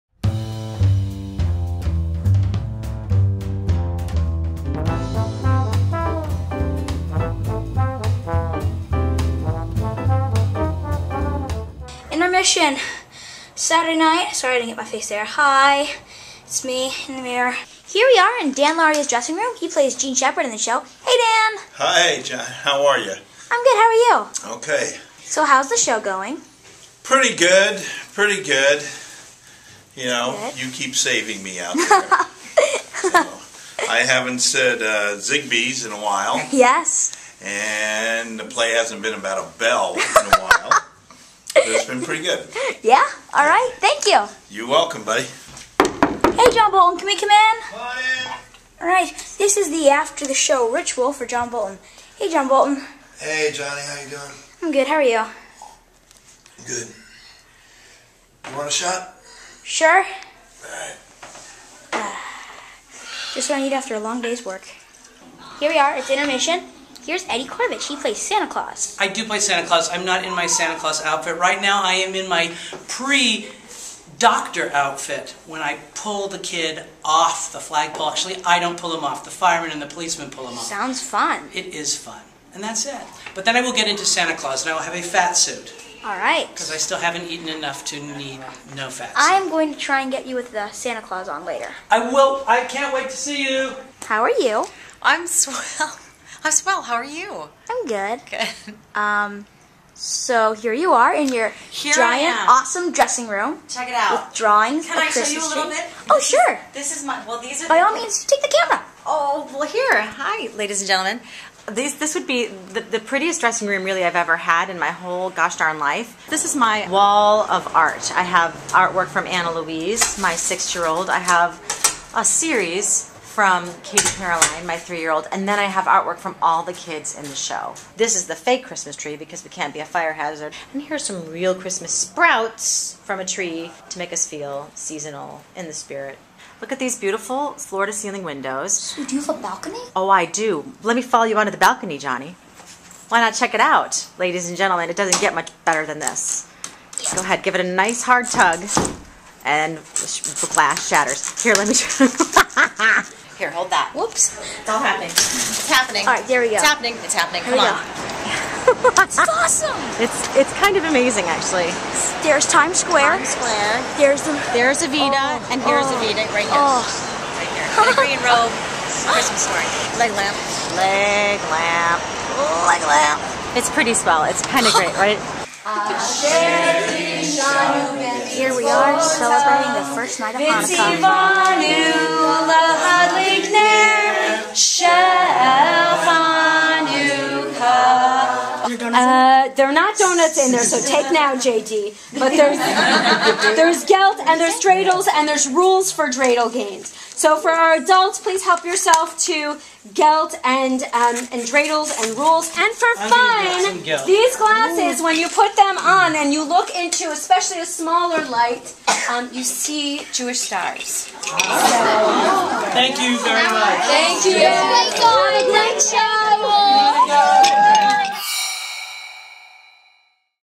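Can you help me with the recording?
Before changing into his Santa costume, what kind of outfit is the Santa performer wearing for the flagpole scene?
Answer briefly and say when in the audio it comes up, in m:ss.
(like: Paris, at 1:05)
Pre doctor outfit, at 1:12.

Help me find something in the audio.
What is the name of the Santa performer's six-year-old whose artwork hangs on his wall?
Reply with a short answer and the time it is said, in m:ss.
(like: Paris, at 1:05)
Anna Louise, at 1:59.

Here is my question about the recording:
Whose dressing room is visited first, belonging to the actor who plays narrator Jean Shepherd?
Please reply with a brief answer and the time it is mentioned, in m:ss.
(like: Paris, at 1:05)
Dan Lauria, at 0:18.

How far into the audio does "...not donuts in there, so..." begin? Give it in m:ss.
3:09.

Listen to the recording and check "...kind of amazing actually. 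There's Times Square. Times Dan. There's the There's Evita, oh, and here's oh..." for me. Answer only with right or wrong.
wrong.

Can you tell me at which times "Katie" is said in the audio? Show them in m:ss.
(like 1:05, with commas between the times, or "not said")
2:03.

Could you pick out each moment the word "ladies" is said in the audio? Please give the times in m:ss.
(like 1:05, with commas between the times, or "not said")
1:50, 2:24.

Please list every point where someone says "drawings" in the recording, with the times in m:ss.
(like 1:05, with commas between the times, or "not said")
1:44.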